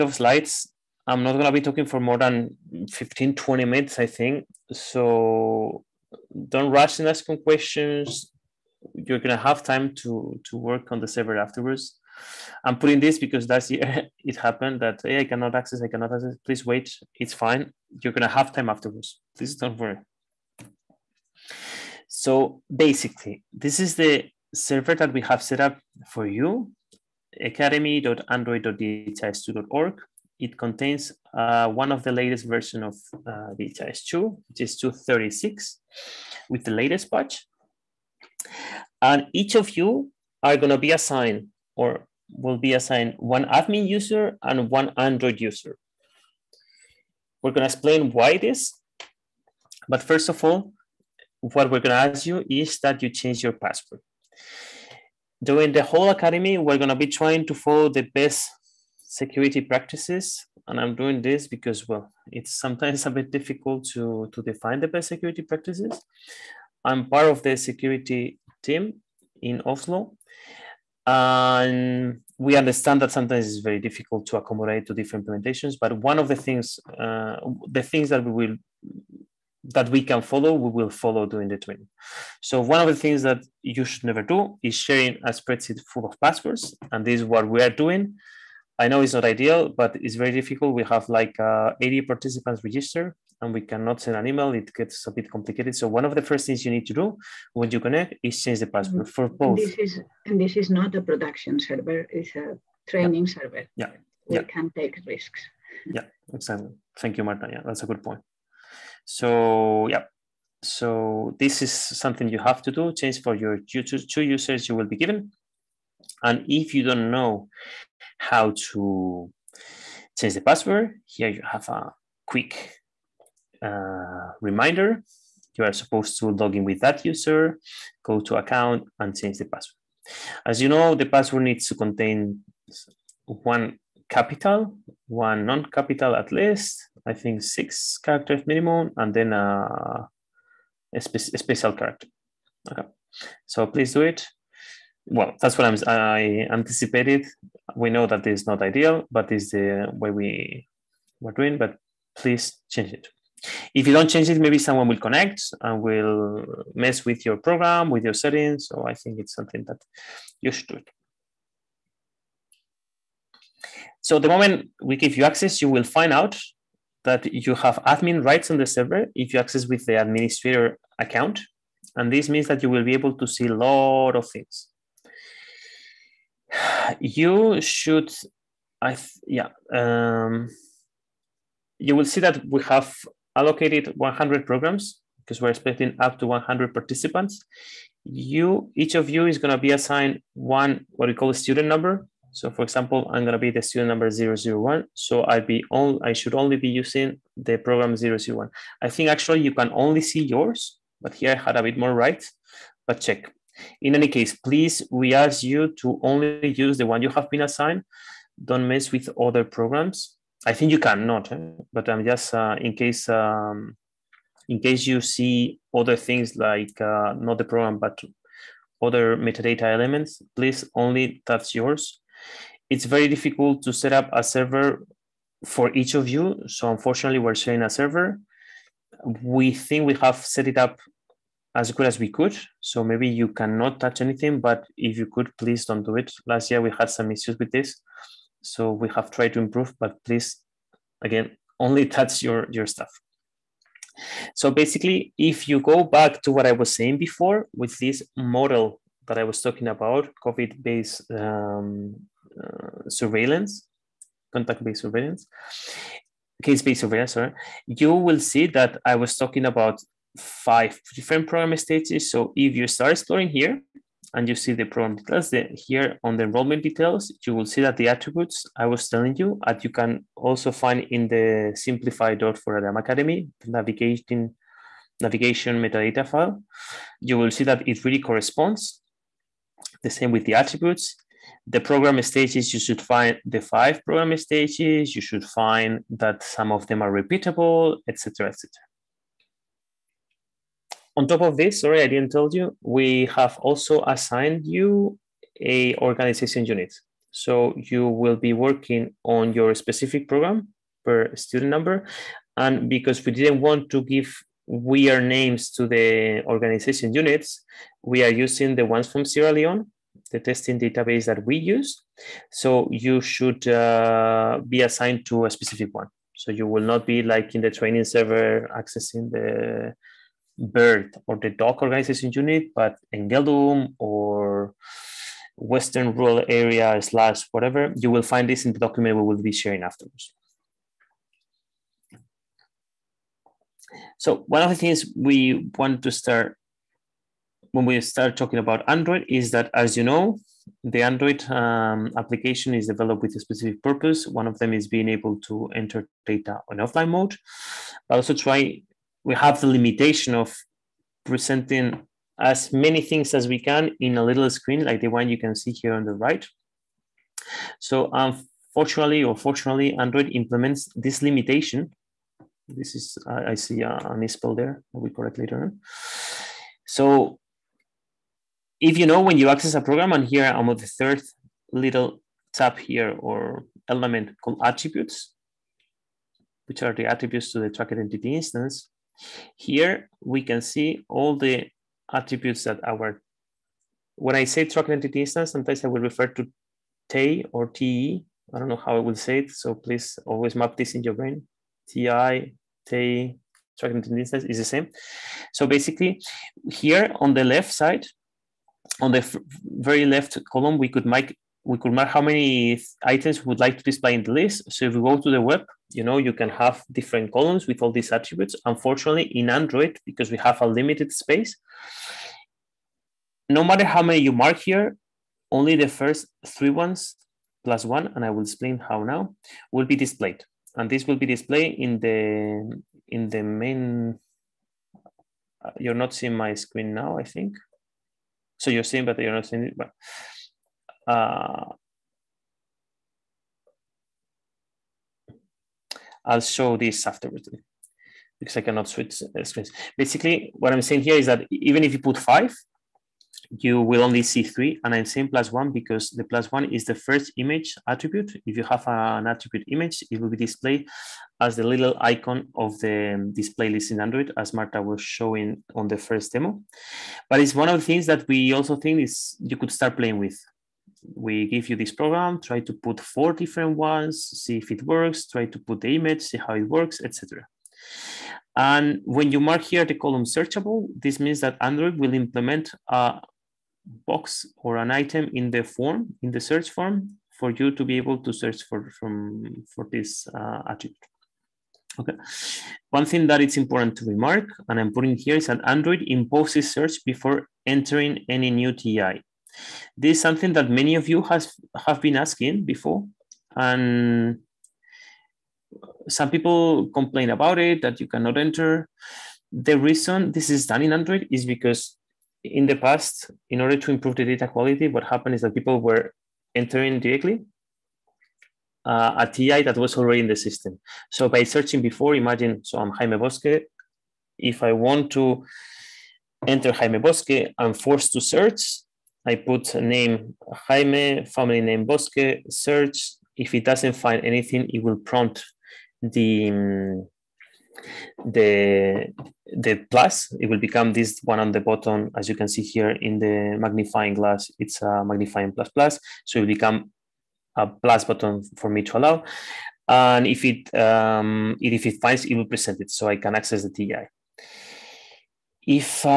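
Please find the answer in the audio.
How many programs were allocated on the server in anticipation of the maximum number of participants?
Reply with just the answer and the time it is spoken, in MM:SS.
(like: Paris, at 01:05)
100, at 03:03.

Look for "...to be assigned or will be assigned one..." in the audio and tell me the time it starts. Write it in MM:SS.
00:40.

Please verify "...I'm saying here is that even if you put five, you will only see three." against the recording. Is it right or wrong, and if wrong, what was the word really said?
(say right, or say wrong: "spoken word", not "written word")
right.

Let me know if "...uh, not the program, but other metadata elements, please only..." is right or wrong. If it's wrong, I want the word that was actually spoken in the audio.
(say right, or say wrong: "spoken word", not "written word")
right.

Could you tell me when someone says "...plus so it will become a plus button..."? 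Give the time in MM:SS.
08:55.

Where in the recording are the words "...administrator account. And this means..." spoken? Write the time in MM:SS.
02:49.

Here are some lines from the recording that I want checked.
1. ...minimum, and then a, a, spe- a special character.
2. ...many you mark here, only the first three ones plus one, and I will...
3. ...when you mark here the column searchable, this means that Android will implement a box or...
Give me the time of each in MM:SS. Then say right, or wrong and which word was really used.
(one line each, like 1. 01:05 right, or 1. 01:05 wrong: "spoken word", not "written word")
1. 02:18 right
2. 06:53 right
3. 07:48 right.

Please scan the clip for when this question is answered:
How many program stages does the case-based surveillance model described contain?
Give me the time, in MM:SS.
04:20.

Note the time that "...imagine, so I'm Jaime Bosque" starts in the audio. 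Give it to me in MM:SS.
08:31.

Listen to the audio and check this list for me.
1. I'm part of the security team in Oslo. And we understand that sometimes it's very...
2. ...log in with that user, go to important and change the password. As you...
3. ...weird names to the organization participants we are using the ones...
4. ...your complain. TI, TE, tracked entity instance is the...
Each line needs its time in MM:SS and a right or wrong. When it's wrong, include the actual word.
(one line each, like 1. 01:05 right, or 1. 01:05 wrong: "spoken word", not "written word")
1. 01:06 right
2. 02:06 wrong: "account", not "important"
3. 05:04 wrong: "units", not "participants"
4. 06:30 wrong: "brain", not "complain".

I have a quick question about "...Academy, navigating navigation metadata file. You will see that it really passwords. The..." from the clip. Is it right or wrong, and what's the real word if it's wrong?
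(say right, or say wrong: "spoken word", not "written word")
wrong: "corresponds", not "passwords".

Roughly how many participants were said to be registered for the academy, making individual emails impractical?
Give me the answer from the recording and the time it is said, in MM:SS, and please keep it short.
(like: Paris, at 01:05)
80, at 01:31.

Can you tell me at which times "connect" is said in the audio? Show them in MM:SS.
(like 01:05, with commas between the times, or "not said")
01:37, 02:34.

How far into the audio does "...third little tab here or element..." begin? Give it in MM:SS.
06:10.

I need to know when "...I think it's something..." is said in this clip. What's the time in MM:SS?
02:38.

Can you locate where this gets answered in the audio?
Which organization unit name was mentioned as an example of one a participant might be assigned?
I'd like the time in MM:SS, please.
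05:23.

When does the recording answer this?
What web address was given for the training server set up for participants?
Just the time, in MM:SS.
00:27.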